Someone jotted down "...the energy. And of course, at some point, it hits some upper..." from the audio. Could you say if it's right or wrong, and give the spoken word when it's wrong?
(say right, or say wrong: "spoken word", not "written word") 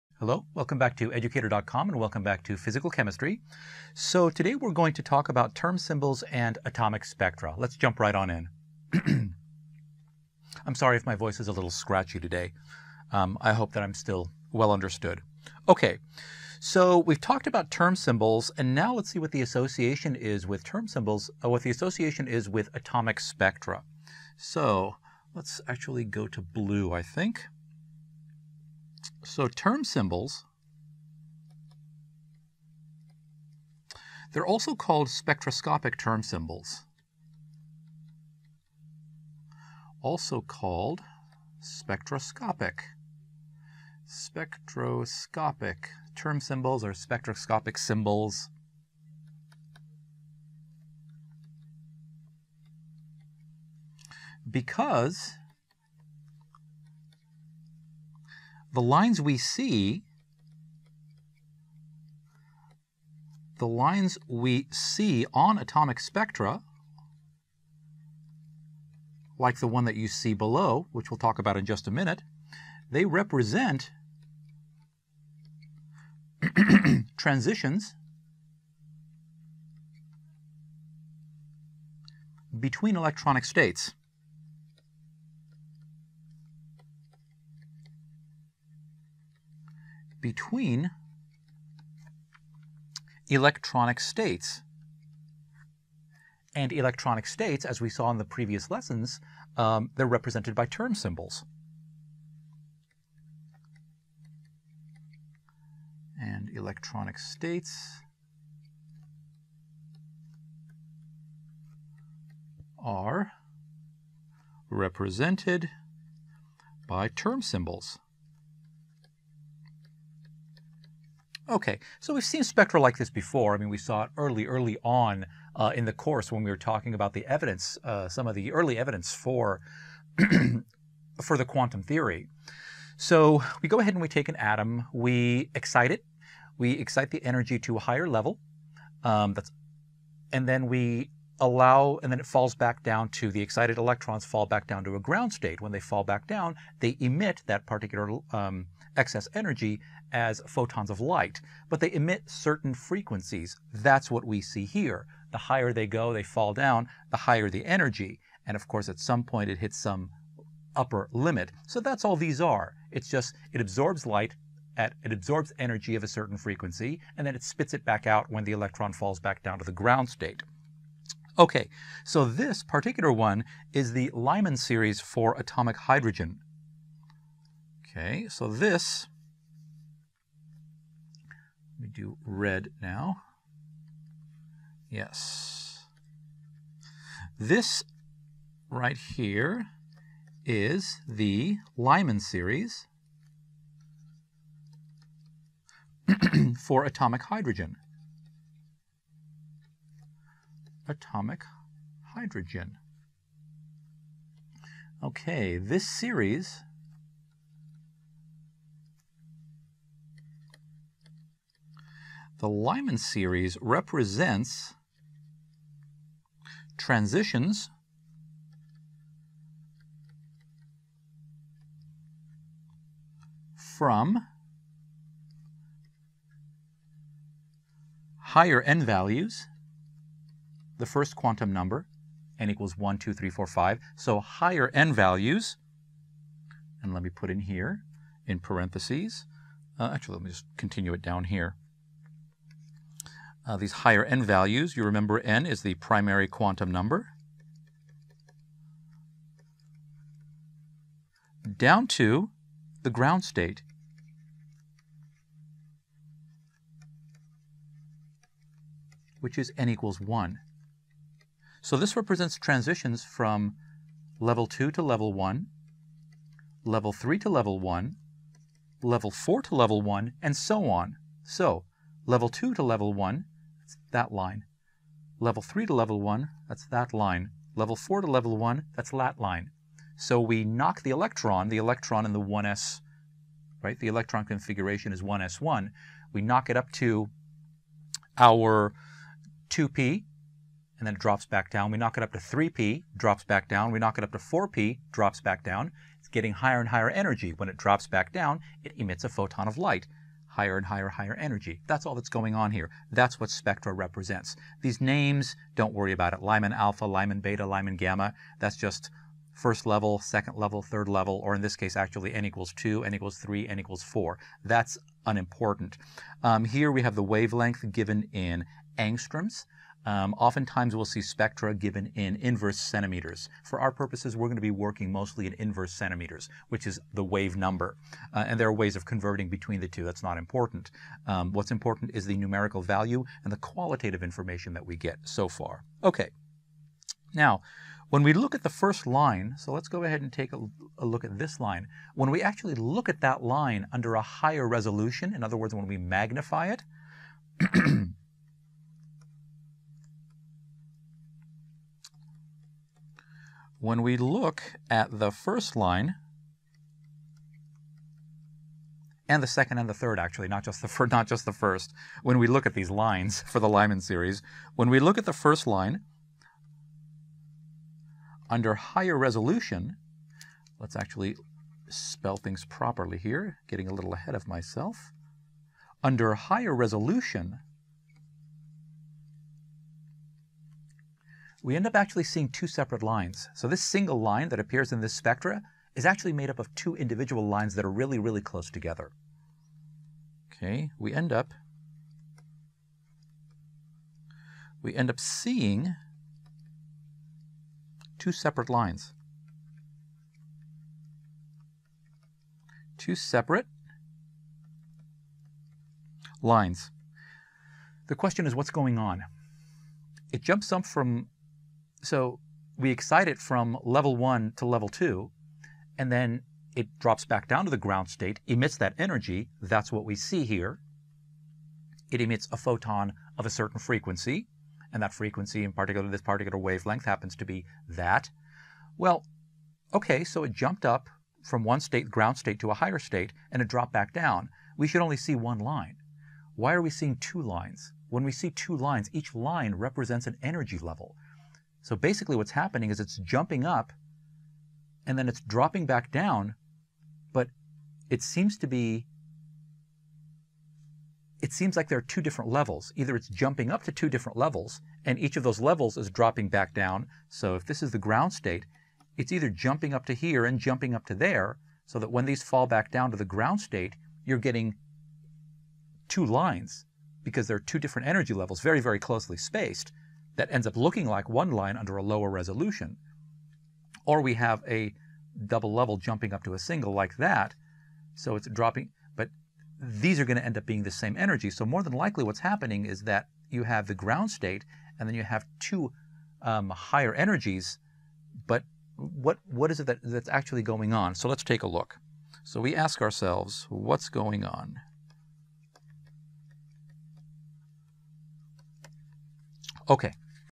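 right.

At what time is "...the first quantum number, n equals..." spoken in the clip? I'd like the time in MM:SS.
03:50.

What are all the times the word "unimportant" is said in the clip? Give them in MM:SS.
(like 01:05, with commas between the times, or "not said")
05:15.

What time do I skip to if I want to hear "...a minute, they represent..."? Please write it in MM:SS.
01:11.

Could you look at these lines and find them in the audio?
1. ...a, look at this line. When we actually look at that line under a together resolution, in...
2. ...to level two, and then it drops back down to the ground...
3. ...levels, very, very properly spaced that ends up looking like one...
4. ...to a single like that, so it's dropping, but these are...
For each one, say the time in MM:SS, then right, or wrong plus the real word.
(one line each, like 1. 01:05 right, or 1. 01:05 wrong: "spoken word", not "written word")
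1. 05:40 wrong: "higher", not "together"
2. 06:54 right
3. 07:48 wrong: "closely", not "properly"
4. 07:56 right.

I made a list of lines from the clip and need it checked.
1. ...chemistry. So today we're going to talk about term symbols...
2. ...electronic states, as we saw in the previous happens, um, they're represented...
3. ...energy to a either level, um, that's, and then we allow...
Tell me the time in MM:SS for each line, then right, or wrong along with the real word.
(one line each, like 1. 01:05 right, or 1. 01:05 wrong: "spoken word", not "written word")
1. 00:02 right
2. 01:36 wrong: "lessons", not "happens"
3. 02:17 wrong: "higher", not "either".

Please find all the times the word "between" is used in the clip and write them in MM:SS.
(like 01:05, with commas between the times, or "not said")
01:22, 01:30, 05:29.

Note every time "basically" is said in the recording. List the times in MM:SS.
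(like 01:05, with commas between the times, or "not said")
07:21.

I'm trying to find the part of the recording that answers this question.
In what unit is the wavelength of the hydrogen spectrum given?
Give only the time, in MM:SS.
05:18.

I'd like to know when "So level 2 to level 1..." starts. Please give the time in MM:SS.
04:31.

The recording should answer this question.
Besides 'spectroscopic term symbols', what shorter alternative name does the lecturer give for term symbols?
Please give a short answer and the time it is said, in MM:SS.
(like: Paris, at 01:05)
Spectroscopic symbols, at 00:46.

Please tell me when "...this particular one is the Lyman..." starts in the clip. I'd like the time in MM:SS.
02:52.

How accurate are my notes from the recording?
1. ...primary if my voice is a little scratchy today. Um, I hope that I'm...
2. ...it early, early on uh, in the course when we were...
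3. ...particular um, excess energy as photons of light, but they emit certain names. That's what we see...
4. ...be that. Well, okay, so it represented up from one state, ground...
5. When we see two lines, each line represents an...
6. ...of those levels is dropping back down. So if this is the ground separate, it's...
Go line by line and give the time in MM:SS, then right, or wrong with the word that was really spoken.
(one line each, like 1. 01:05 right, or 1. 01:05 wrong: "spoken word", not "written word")
1. 00:10 wrong: "sorry", not "primary"
2. 02:04 right
3. 02:27 wrong: "frequencies", not "names"
4. 07:07 wrong: "jumped", not "represented"
5. 07:17 right
6. 07:35 wrong: "state", not "separate".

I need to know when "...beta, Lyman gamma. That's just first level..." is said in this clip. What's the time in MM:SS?
05:07.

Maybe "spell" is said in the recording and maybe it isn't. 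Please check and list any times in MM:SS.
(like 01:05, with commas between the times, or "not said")
06:11.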